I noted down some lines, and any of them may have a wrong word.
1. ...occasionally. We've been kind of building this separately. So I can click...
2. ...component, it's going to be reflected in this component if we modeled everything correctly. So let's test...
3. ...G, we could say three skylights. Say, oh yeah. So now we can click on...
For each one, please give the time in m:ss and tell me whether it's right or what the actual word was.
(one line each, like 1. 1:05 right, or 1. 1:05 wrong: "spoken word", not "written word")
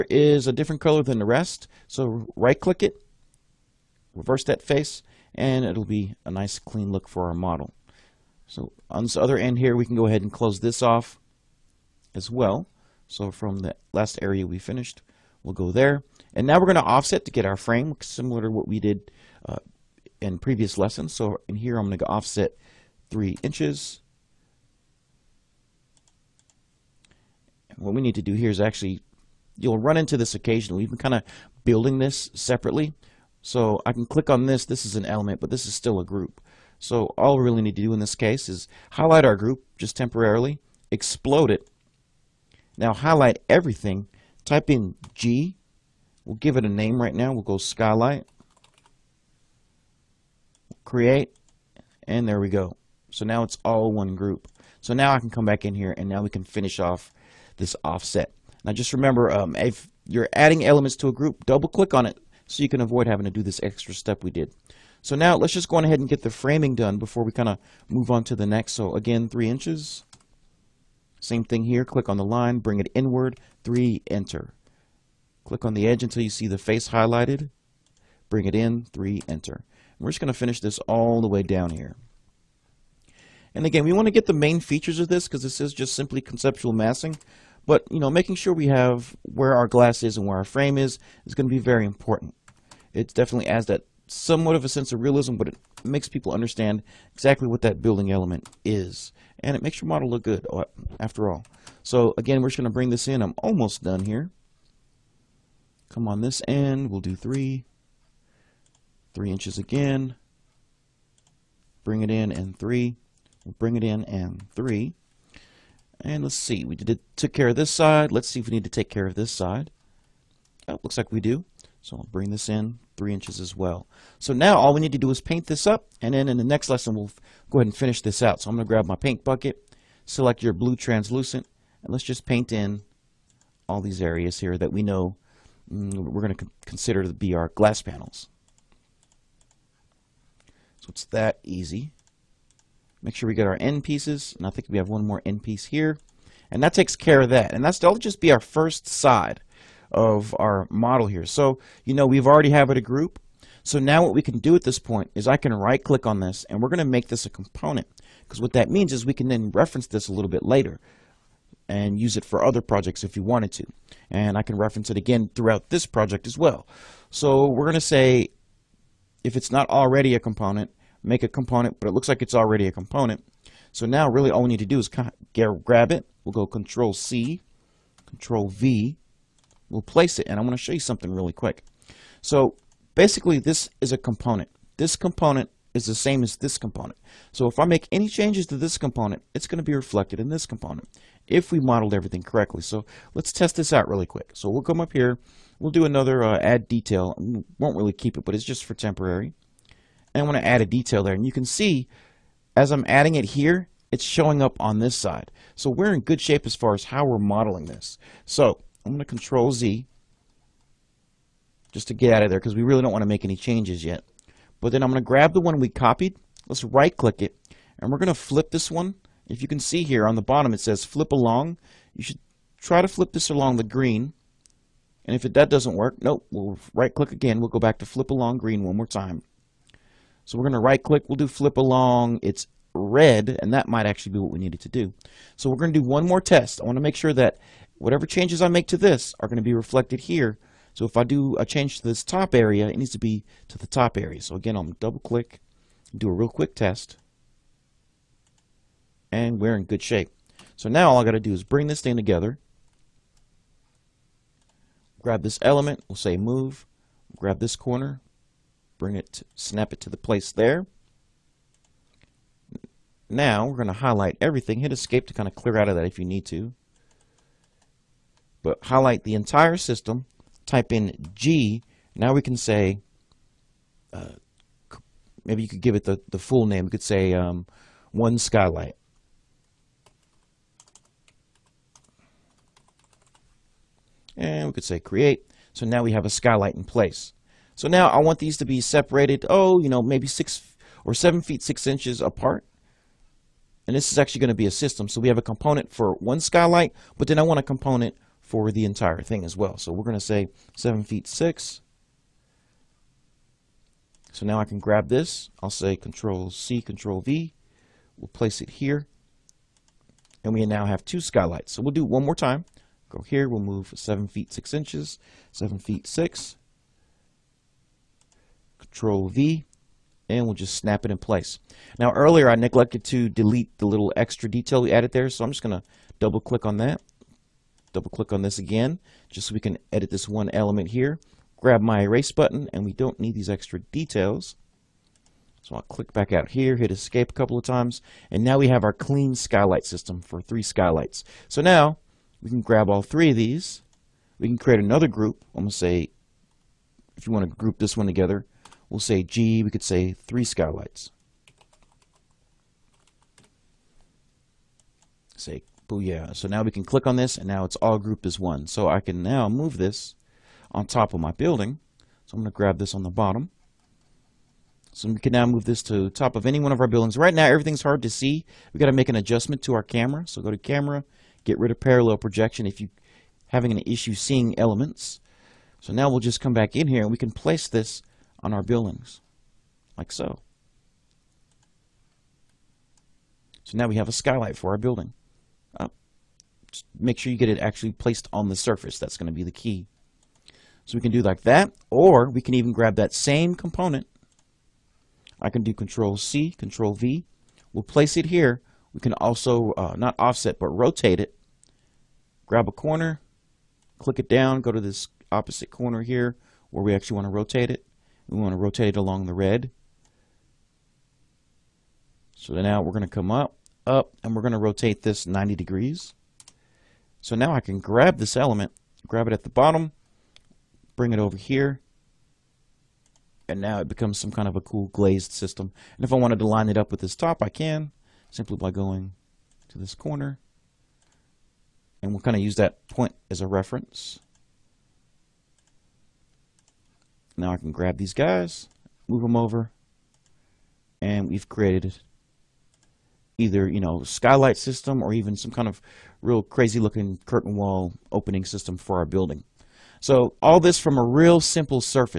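1. 0:30 right
2. 3:08 right
3. 5:49 right.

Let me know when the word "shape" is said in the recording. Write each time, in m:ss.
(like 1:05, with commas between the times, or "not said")
3:26, 4:09.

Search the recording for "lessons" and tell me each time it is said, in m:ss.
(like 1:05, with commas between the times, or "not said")
0:20, 2:06.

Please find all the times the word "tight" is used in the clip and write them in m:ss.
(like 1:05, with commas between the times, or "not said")
not said.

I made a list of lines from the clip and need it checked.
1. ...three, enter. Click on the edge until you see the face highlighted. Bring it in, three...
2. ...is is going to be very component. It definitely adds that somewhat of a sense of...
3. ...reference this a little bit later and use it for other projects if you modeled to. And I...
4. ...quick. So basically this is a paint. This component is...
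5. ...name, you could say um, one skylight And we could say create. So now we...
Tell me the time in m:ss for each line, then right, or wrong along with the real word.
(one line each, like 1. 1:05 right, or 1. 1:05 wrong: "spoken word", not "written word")
1. 1:13 right
2. 1:30 wrong: "important", not "component"
3. 2:39 wrong: "wanted", not "modeled"
4. 3:01 wrong: "component", not "paint"
5. 4:36 right.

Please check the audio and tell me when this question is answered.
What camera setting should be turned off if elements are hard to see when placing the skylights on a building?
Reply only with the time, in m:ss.
6:11.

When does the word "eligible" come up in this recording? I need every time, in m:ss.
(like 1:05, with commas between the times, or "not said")
not said.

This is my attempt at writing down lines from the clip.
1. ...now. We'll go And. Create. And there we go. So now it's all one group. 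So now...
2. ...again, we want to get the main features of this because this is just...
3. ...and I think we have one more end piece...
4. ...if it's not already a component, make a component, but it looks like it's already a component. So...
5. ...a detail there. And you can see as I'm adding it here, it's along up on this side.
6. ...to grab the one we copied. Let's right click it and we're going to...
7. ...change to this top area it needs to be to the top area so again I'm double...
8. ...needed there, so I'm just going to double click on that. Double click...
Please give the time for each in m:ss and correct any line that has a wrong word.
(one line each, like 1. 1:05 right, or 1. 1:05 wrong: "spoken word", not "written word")
1. 0:47 wrong: "Skylight", not "And"
2. 1:23 right
3. 2:24 right
4. 2:49 right
5. 3:20 wrong: "showing", not "along"
6. 3:35 right
7. 4:01 right
8. 5:24 wrong: "added", not "needed".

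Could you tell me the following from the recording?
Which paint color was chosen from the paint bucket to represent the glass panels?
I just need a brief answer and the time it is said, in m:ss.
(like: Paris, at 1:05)
blue translucent, at 2:10.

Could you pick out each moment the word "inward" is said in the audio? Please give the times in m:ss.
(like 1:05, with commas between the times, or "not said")
1:12.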